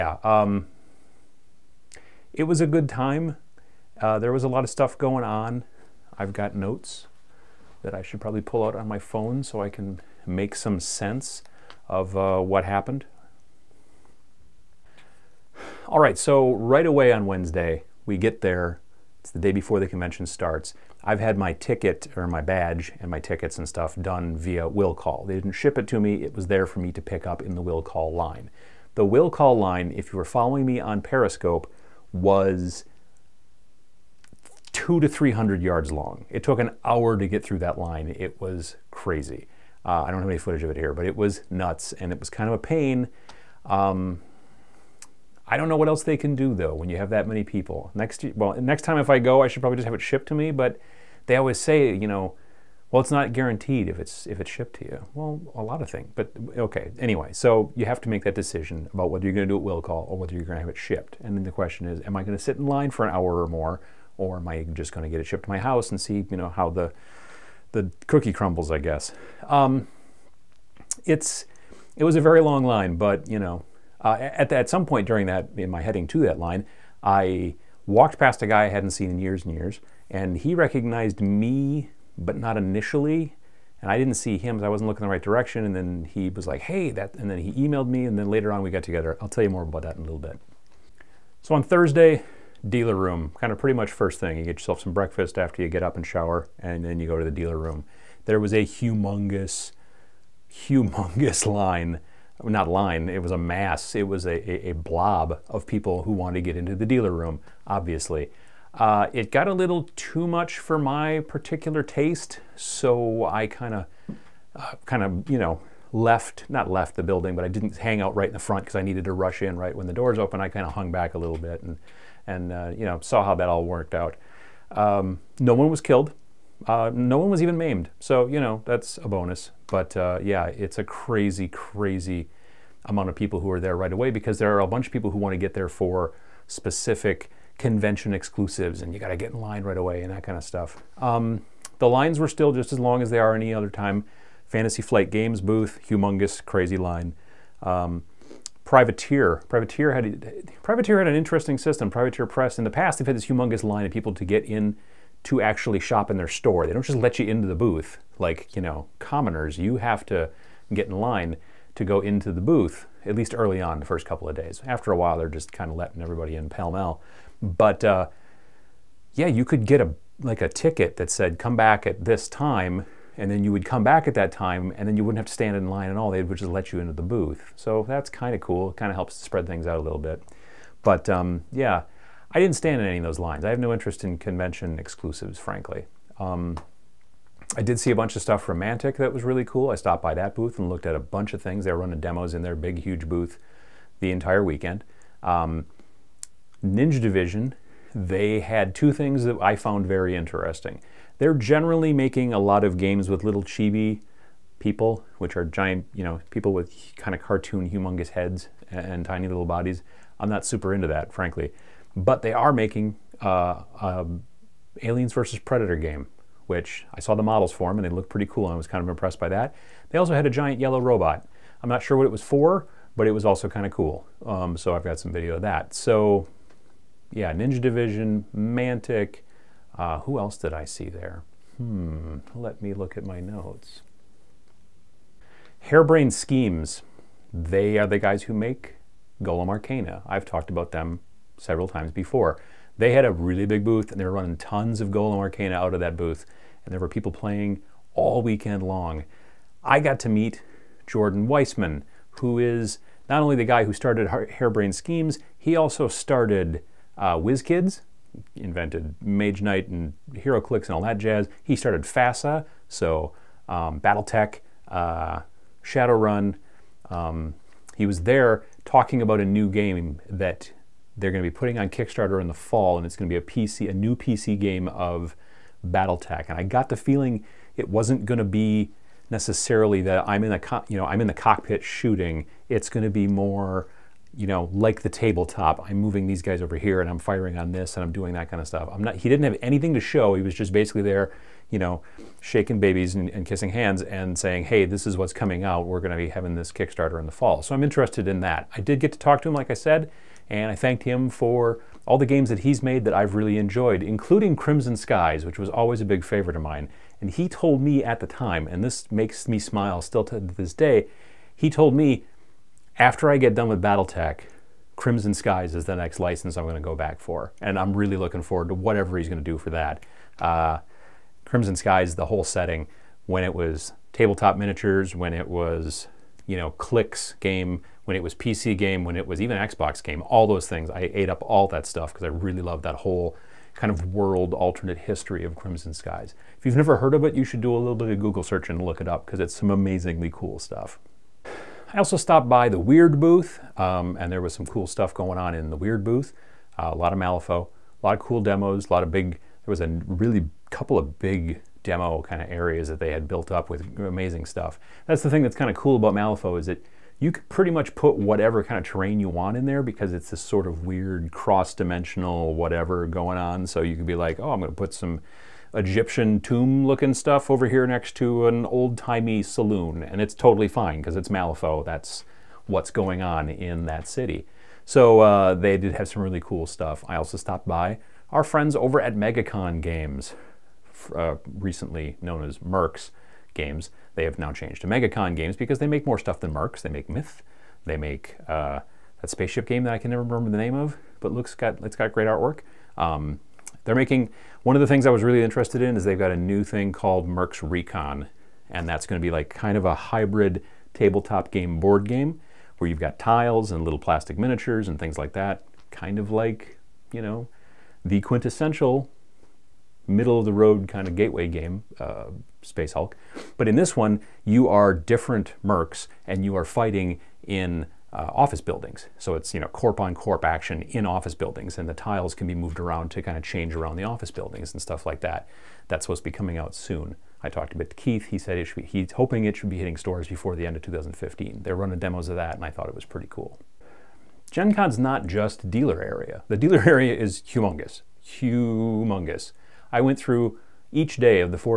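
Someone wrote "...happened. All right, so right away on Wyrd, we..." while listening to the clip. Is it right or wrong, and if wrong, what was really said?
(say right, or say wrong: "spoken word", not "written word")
wrong: "Wednesday", not "Wyrd".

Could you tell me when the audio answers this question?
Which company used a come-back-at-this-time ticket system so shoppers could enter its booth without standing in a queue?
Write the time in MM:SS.
02:31.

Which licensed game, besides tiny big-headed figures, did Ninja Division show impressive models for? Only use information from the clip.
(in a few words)
Aliens versus Predator.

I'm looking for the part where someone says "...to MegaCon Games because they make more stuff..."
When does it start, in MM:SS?
06:24.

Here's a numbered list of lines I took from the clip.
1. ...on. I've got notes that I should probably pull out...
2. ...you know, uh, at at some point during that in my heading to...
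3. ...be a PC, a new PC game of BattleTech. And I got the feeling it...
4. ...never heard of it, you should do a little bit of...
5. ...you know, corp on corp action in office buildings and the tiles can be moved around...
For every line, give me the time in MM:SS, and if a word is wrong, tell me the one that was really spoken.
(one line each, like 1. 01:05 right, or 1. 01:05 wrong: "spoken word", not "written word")
1. 00:05 right
2. 01:13 right
3. 04:33 right
4. 05:36 right
5. 06:59 right.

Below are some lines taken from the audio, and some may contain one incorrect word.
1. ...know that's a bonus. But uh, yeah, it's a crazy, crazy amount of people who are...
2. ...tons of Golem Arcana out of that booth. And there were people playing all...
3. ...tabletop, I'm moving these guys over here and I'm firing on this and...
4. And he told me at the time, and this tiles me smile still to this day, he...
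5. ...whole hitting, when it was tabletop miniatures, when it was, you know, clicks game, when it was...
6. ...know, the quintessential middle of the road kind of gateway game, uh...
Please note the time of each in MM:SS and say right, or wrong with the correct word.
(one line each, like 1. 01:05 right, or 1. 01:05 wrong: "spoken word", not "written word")
1. 02:08 right
2. 04:04 right
3. 04:44 right
4. 05:06 wrong: "makes", not "tiles"
5. 05:22 wrong: "setting", not "hitting"
6. 06:47 right.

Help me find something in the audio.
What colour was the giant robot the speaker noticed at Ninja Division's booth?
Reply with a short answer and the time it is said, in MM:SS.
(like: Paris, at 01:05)
yellow, at 03:40.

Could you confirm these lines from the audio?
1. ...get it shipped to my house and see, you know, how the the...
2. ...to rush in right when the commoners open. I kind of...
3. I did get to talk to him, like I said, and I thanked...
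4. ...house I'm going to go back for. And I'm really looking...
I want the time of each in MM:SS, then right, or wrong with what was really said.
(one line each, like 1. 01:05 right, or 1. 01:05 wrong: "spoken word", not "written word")
1. 01:05 right
2. 01:59 wrong: "doors", not "commoners"
3. 04:58 right
4. 05:15 wrong: "license", not "house".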